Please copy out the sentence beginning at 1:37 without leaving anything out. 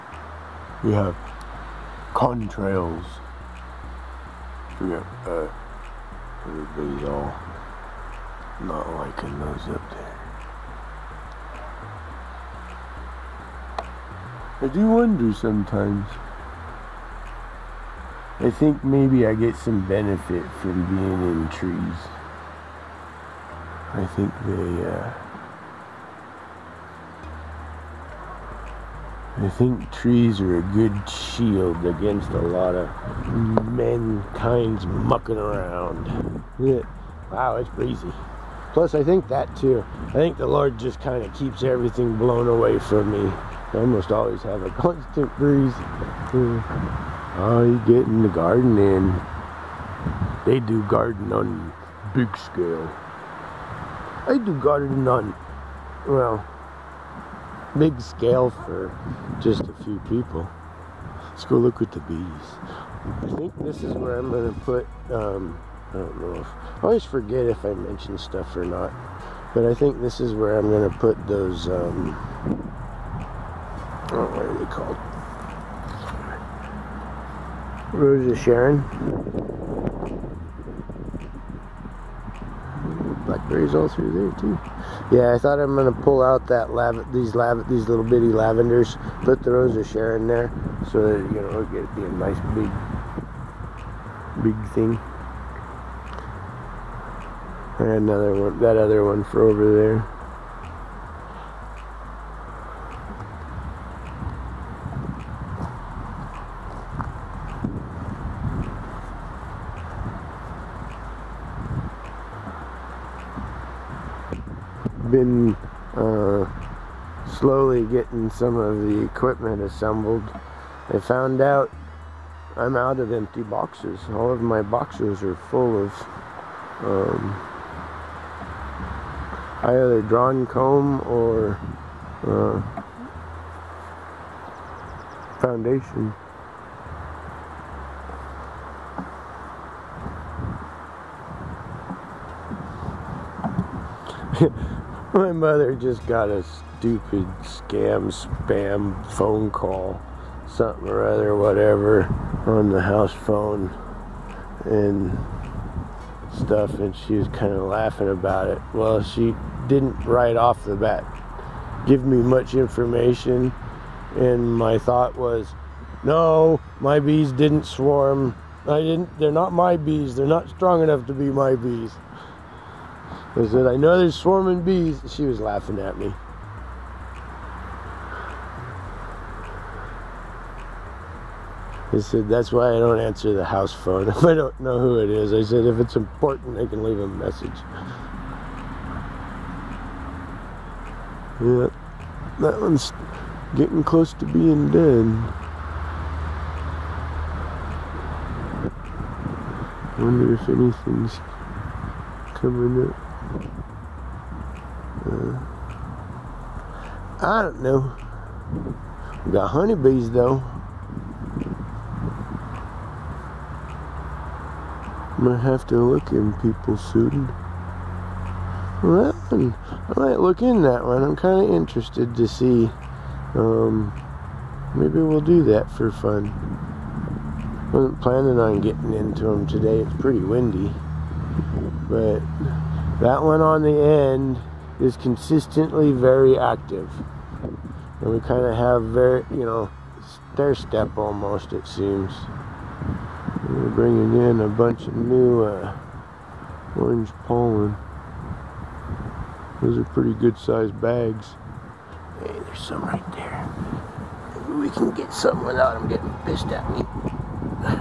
And another one, that other one for over there.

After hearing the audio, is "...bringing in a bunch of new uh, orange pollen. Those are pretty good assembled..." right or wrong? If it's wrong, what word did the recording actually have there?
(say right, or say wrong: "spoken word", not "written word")
wrong: "sized", not "assembled".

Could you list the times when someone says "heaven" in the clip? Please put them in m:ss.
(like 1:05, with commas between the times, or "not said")
not said.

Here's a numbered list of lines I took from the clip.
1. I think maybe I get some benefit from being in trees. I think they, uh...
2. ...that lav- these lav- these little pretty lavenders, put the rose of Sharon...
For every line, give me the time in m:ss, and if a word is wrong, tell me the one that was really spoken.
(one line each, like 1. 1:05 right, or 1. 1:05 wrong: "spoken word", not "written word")
1. 0:18 right
2. 1:26 wrong: "bitty", not "pretty".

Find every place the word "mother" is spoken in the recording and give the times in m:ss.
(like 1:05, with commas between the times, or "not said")
2:25.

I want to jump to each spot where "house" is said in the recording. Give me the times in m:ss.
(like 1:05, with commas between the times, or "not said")
2:32, 3:03.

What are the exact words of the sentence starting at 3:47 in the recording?
Wasn't planning on getting into them today.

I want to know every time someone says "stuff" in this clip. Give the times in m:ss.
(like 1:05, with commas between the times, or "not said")
1:08, 2:36.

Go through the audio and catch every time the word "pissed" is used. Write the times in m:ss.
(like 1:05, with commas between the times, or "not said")
4:16.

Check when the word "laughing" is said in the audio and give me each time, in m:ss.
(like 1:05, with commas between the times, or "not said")
2:37, 2:55.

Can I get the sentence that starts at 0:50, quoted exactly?
They do garden on big scale.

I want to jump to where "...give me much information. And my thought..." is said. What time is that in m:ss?
2:41.